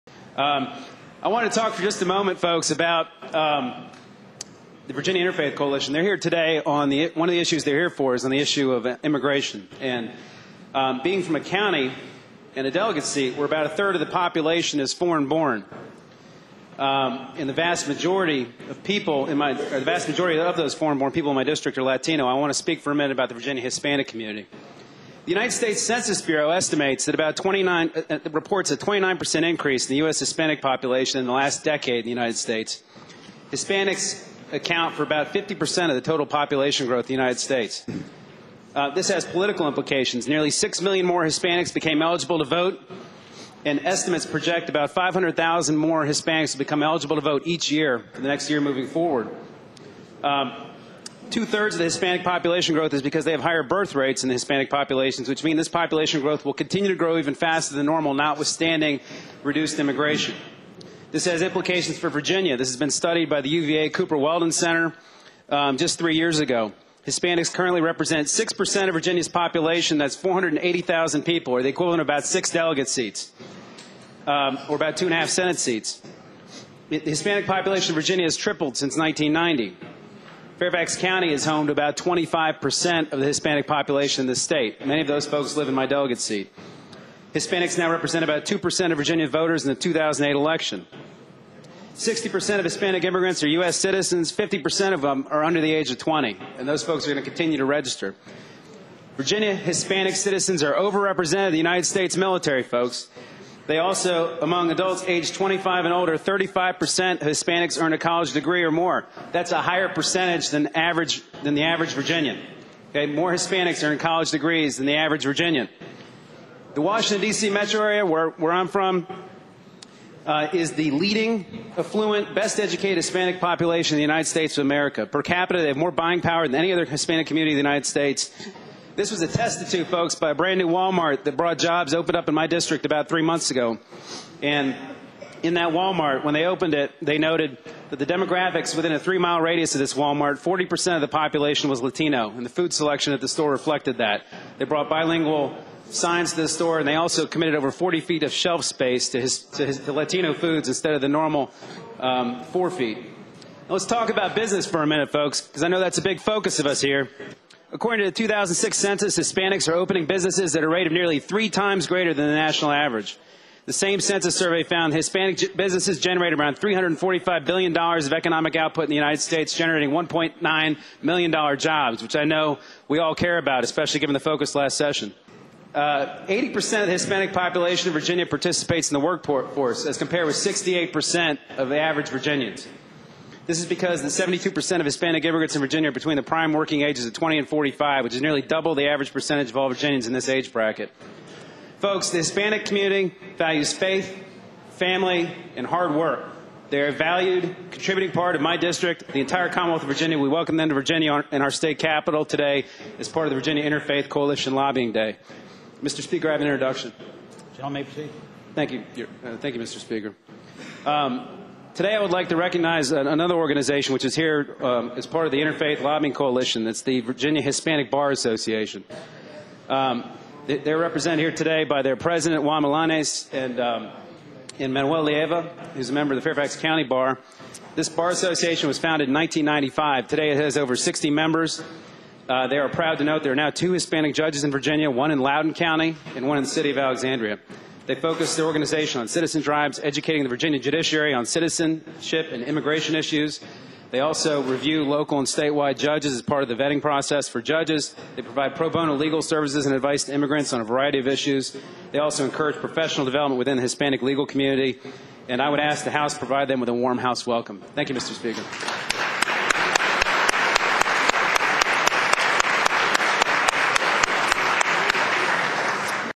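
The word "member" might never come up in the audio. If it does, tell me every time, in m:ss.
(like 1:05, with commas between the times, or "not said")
3:45, 3:51.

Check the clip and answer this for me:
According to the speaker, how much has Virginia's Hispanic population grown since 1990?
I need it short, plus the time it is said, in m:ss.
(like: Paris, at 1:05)
tripled, at 1:18.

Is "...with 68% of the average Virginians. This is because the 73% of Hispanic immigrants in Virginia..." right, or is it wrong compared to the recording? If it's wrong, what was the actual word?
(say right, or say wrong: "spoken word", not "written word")
wrong: "72", not "73".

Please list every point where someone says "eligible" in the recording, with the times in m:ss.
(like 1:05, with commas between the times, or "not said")
0:42, 0:46.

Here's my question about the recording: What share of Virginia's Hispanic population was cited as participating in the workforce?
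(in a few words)
80%.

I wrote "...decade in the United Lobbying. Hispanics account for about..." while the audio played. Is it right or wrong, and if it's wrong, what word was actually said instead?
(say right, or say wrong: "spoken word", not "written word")
wrong: "States", not "Lobbying".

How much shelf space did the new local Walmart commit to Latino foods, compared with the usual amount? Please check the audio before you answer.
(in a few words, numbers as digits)
over 40 feet.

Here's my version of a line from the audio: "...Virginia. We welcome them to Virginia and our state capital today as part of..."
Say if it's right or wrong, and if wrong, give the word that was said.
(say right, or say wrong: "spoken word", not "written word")
right.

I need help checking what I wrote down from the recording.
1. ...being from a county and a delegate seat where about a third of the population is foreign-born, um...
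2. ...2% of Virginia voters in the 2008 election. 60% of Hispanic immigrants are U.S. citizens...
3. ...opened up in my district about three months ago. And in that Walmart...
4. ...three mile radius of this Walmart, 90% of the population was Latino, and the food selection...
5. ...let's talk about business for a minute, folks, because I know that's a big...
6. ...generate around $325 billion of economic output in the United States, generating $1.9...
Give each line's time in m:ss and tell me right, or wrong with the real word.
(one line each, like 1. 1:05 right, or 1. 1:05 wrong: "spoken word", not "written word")
1. 0:11 right
2. 1:28 right
3. 2:11 right
4. 2:18 wrong: "40", not "90"
5. 2:33 right
6. 2:46 wrong: "345", not "325".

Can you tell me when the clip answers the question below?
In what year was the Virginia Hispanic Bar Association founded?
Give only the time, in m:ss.
3:49.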